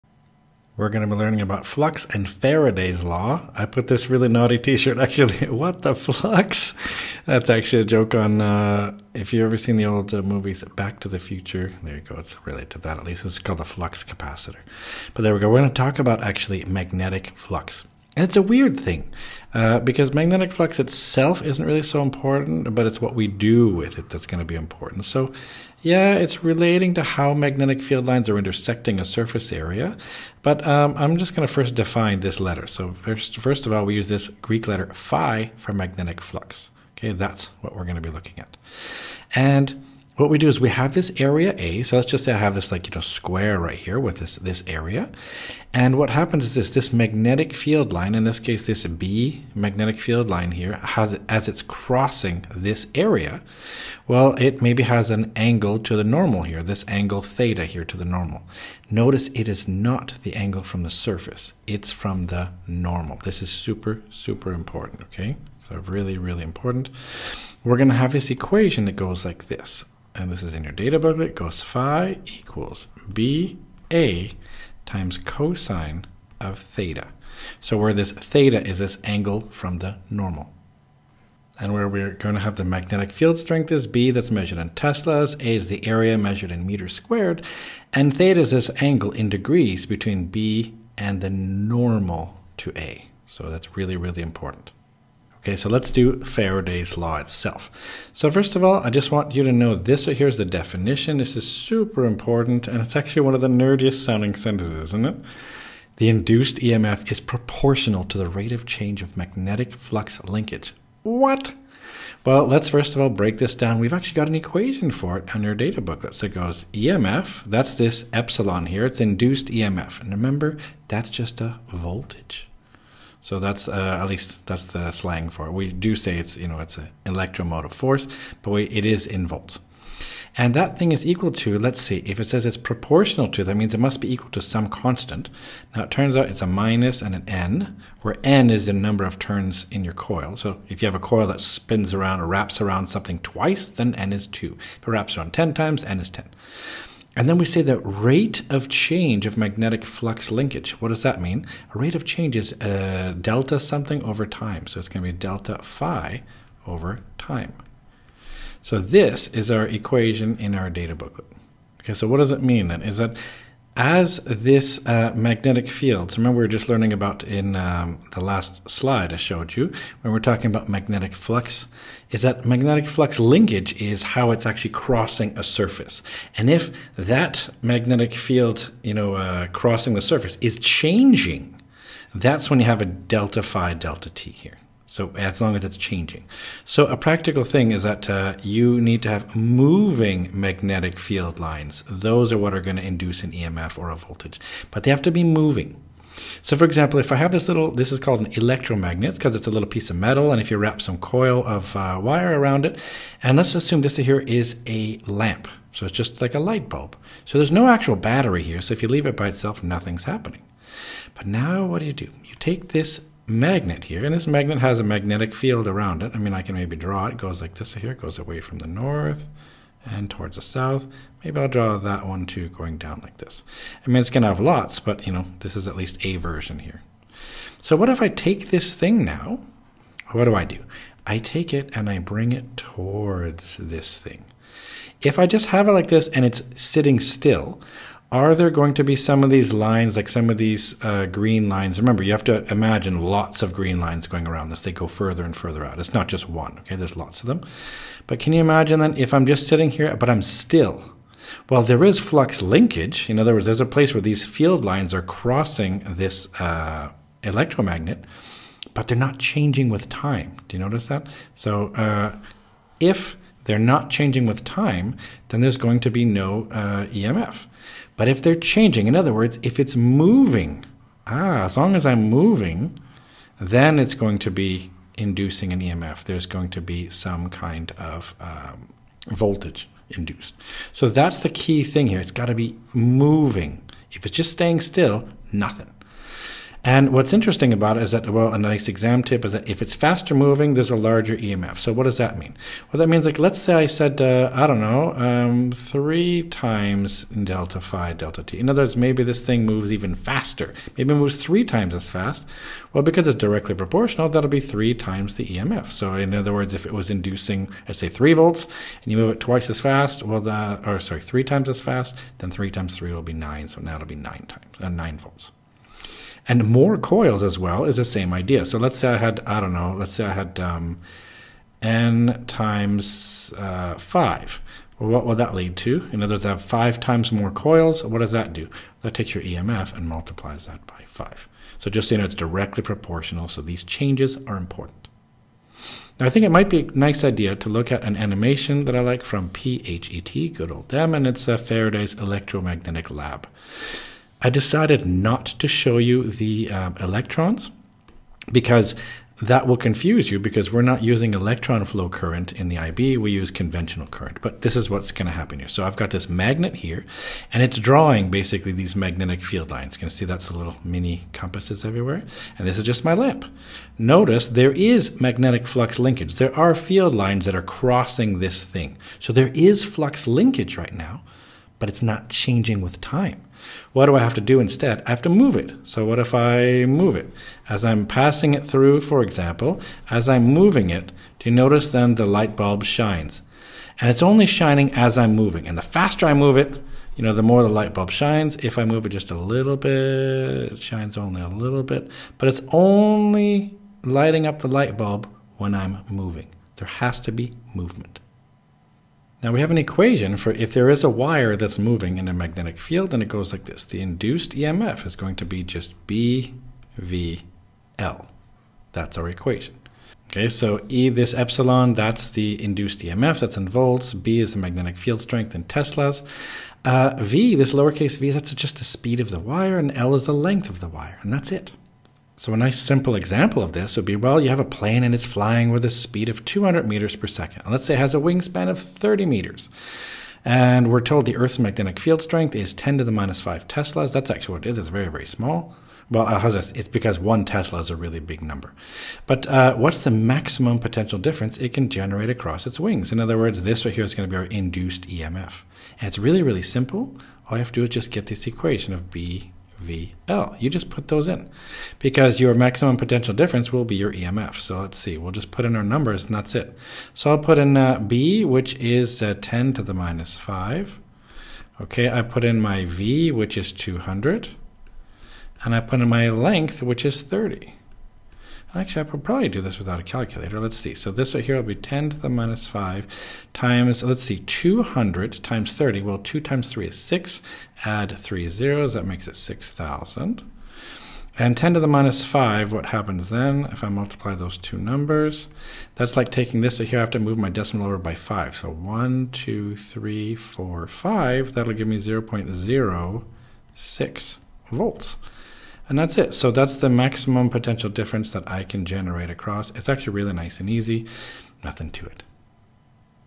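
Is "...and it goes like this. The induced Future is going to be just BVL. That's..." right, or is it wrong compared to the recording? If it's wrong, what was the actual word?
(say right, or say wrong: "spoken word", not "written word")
wrong: "EMF", not "Future".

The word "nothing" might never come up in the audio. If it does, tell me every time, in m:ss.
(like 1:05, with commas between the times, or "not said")
3:29, 4:45, 8:21.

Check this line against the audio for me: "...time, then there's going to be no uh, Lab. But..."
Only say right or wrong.
wrong.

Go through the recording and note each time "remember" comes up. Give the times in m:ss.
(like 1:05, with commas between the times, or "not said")
2:00, 2:46, 4:01.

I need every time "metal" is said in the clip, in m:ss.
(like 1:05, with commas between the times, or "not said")
3:19.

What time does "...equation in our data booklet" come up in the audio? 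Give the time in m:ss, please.
2:39.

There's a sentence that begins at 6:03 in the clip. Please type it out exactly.
Notice there is magnetic flux linkage.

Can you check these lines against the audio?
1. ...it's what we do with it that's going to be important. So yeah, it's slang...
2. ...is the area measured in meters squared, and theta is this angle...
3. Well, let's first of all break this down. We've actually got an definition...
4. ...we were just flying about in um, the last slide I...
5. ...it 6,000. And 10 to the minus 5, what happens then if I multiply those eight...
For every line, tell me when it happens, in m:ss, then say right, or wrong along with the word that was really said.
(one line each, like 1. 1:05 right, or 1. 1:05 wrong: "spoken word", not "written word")
1. 0:22 wrong: "relating", not "slang"
2. 1:25 right
3. 1:52 wrong: "equation", not "definition"
4. 2:46 wrong: "learning", not "flying"
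5. 7:59 wrong: "two", not "eight".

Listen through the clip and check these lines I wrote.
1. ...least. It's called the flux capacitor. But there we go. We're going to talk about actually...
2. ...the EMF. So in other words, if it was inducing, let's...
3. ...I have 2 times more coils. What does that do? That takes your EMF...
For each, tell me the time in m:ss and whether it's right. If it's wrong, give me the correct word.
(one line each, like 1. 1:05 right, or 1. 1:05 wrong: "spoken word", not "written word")
1. 0:13 right
2. 5:05 right
3. 5:26 wrong: "5", not "2".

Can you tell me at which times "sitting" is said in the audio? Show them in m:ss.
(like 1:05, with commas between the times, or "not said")
3:56, 4:09.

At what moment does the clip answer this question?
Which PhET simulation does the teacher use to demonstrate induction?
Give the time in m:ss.
5:41.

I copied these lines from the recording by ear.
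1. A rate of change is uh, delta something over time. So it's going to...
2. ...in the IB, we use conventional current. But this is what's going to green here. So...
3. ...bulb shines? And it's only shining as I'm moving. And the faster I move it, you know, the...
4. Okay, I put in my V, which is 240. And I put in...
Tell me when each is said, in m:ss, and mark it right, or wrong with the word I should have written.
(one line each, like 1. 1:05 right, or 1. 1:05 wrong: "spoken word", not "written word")
1. 2:31 right
2. 5:52 wrong: "happen", not "green"
3. 6:22 right
4. 7:41 wrong: "200", not "240".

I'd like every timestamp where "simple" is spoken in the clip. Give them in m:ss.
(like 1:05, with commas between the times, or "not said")
7:02, 7:26.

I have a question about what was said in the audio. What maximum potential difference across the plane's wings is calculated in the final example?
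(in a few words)
0.06 volts.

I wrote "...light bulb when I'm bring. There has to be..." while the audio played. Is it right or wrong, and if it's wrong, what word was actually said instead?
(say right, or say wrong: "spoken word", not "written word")
wrong: "moving", not "bring".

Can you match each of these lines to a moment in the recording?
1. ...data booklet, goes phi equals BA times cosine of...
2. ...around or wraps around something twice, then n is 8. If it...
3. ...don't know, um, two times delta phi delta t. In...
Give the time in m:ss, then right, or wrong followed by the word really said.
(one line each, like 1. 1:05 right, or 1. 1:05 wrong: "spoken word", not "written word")
1. 1:10 right
2. 2:21 wrong: "2", not "8"
3. 4:54 wrong: "three", not "two".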